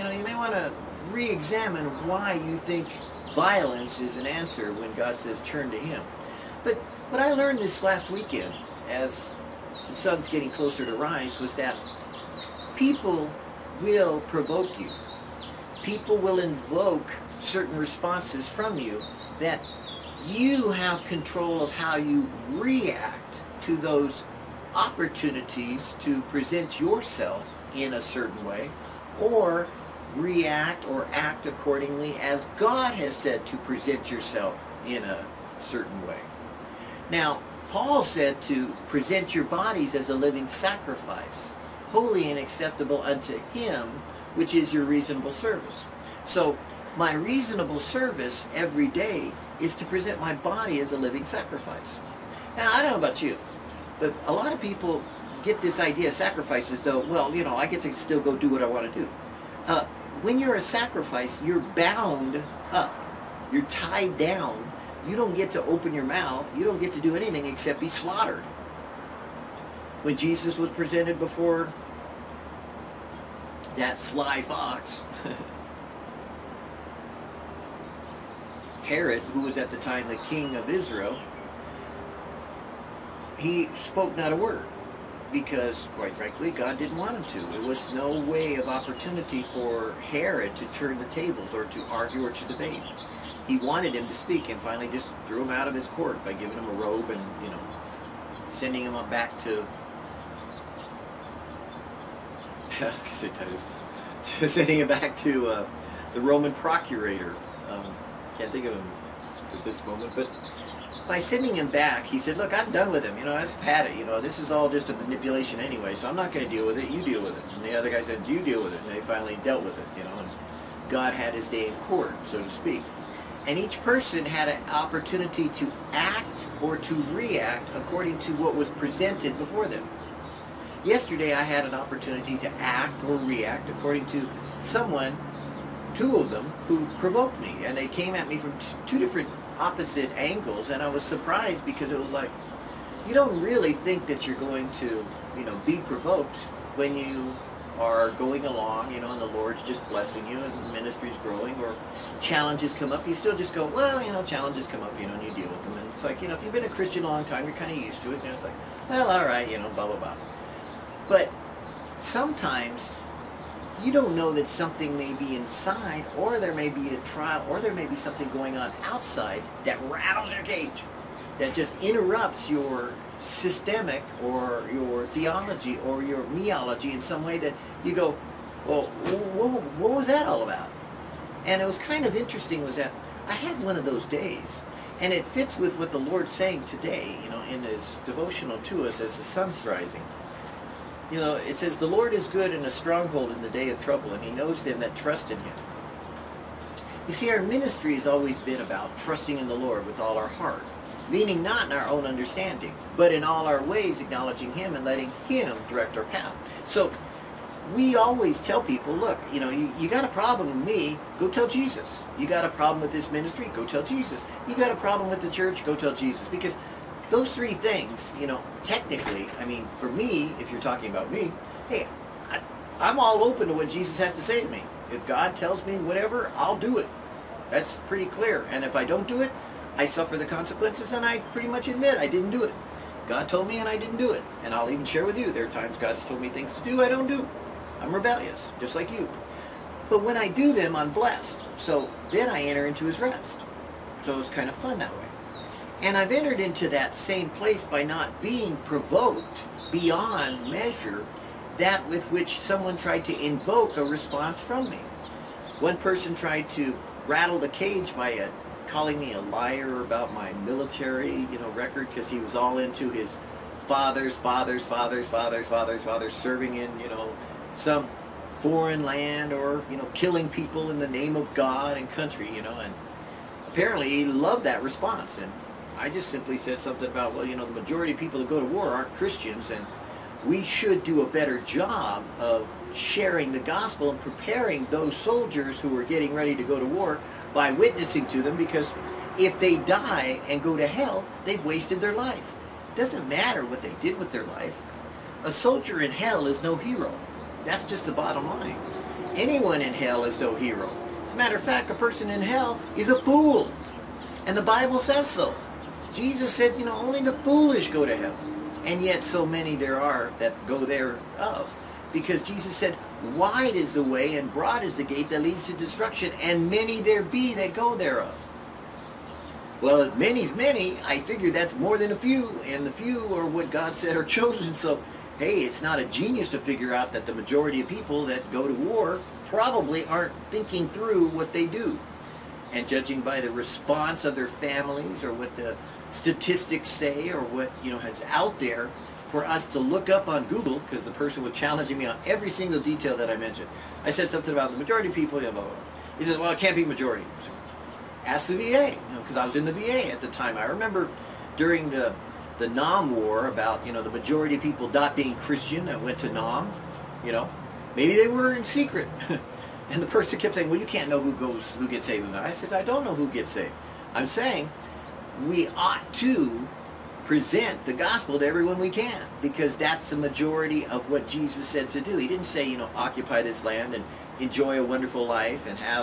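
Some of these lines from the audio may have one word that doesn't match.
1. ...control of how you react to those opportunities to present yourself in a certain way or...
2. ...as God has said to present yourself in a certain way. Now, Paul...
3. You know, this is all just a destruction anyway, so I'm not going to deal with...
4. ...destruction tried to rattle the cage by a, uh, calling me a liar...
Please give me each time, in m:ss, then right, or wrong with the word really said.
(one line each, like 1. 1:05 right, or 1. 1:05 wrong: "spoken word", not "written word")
1. 0:21 right
2. 0:32 right
3. 1:53 wrong: "manipulation", not "destruction"
4. 4:15 wrong: "person", not "destruction".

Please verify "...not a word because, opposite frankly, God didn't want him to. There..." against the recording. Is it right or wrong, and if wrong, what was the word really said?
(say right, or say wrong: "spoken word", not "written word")
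wrong: "quite", not "opposite".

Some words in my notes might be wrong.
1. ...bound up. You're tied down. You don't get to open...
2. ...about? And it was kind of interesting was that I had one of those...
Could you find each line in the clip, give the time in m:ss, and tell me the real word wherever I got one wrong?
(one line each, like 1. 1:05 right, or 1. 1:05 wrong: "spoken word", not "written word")
1. 1:01 right
2. 3:00 right.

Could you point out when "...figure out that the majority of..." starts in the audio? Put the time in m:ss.
5:26.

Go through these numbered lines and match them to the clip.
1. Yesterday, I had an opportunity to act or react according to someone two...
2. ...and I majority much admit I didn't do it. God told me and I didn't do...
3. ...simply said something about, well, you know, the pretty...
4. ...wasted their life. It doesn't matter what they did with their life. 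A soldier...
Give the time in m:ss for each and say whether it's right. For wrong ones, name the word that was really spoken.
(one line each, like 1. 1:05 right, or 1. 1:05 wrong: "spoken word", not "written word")
1. 2:10 right
2. 3:50 wrong: "pretty", not "majority"
3. 4:36 wrong: "majority", not "pretty"
4. 4:51 right.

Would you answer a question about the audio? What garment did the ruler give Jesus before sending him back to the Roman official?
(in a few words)
a robe.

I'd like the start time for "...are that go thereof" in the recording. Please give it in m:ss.
5:09.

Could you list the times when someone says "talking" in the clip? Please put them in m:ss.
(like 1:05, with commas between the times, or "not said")
3:40.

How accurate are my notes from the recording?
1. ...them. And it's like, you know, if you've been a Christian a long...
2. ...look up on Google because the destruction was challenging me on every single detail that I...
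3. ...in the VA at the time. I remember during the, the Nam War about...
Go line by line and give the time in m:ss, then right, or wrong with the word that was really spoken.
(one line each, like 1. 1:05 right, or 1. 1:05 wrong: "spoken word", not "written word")
1. 2:35 right
2. 5:39 wrong: "person", not "destruction"
3. 5:49 right.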